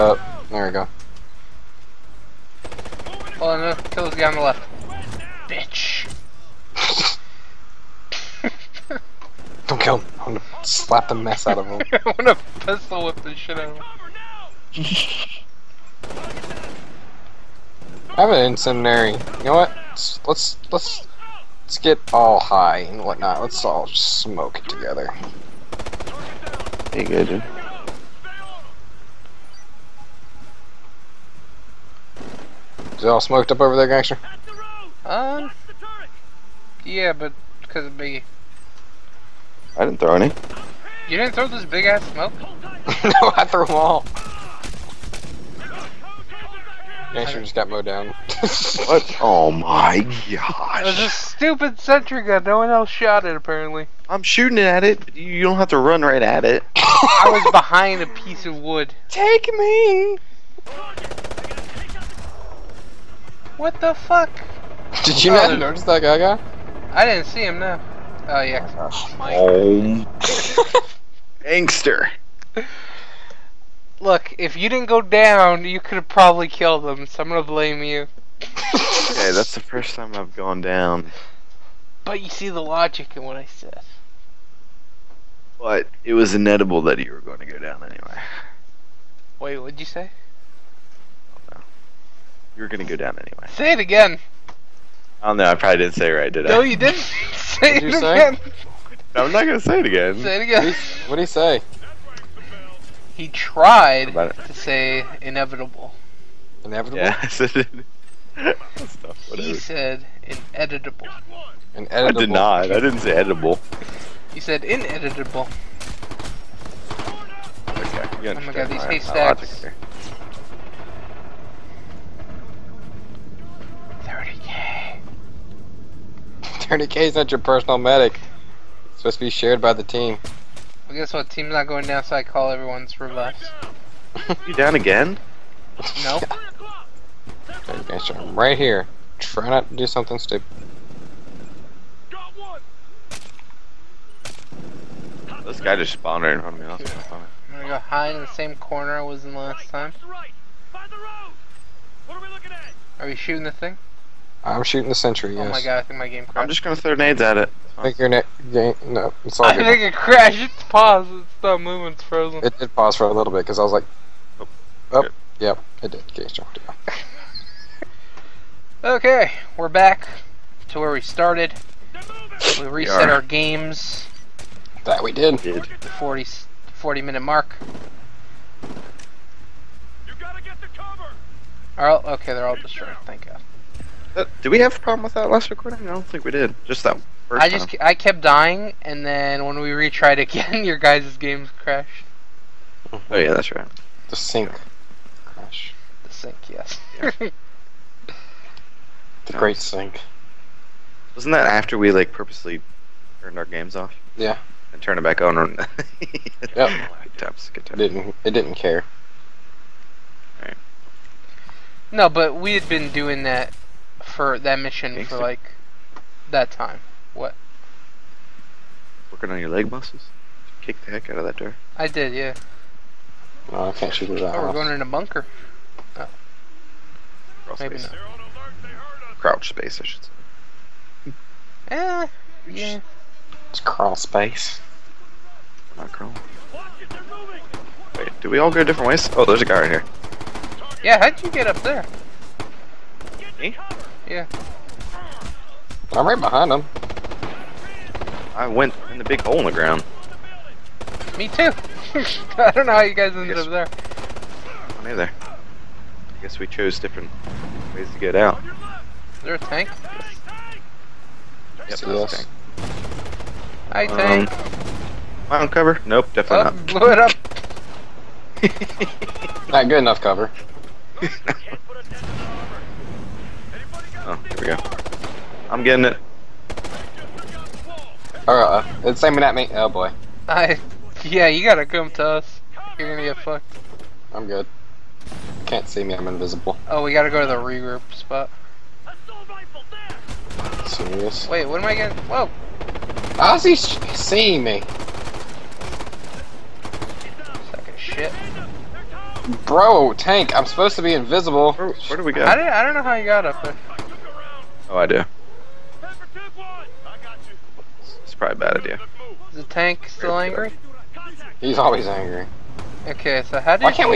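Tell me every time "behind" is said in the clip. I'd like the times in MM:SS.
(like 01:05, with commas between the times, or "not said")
00:57, 04:06.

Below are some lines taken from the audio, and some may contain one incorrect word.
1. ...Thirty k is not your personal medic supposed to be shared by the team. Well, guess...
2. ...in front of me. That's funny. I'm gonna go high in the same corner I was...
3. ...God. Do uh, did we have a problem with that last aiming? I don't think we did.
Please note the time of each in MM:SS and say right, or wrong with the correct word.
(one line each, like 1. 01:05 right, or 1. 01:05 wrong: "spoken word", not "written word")
1. 02:06 right
2. 02:26 right
3. 03:03 wrong: "recording", not "aiming".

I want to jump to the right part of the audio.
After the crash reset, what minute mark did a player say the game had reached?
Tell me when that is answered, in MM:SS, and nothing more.
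02:56.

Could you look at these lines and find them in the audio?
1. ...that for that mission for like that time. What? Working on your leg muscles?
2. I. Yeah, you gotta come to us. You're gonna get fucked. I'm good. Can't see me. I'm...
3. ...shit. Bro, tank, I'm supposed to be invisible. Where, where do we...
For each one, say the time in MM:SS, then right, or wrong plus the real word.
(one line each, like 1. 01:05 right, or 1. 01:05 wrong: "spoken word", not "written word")
1. 03:33 right
2. 04:40 right
3. 04:57 right.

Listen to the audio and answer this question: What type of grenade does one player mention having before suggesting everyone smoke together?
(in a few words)
Incendiary.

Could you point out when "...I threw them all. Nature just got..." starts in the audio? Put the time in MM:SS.
00:43.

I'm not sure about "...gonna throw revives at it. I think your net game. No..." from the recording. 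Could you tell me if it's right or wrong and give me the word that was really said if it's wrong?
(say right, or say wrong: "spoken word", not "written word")
wrong: "nades", not "revives".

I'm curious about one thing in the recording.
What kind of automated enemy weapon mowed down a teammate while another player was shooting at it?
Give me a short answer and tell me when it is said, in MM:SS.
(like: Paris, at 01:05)
Sentry gun, at 00:51.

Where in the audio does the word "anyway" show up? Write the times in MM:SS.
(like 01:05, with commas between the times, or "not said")
01:27, 01:33.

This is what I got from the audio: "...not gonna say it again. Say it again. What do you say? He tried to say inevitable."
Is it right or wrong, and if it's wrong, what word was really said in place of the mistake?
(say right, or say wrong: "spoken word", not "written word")
right.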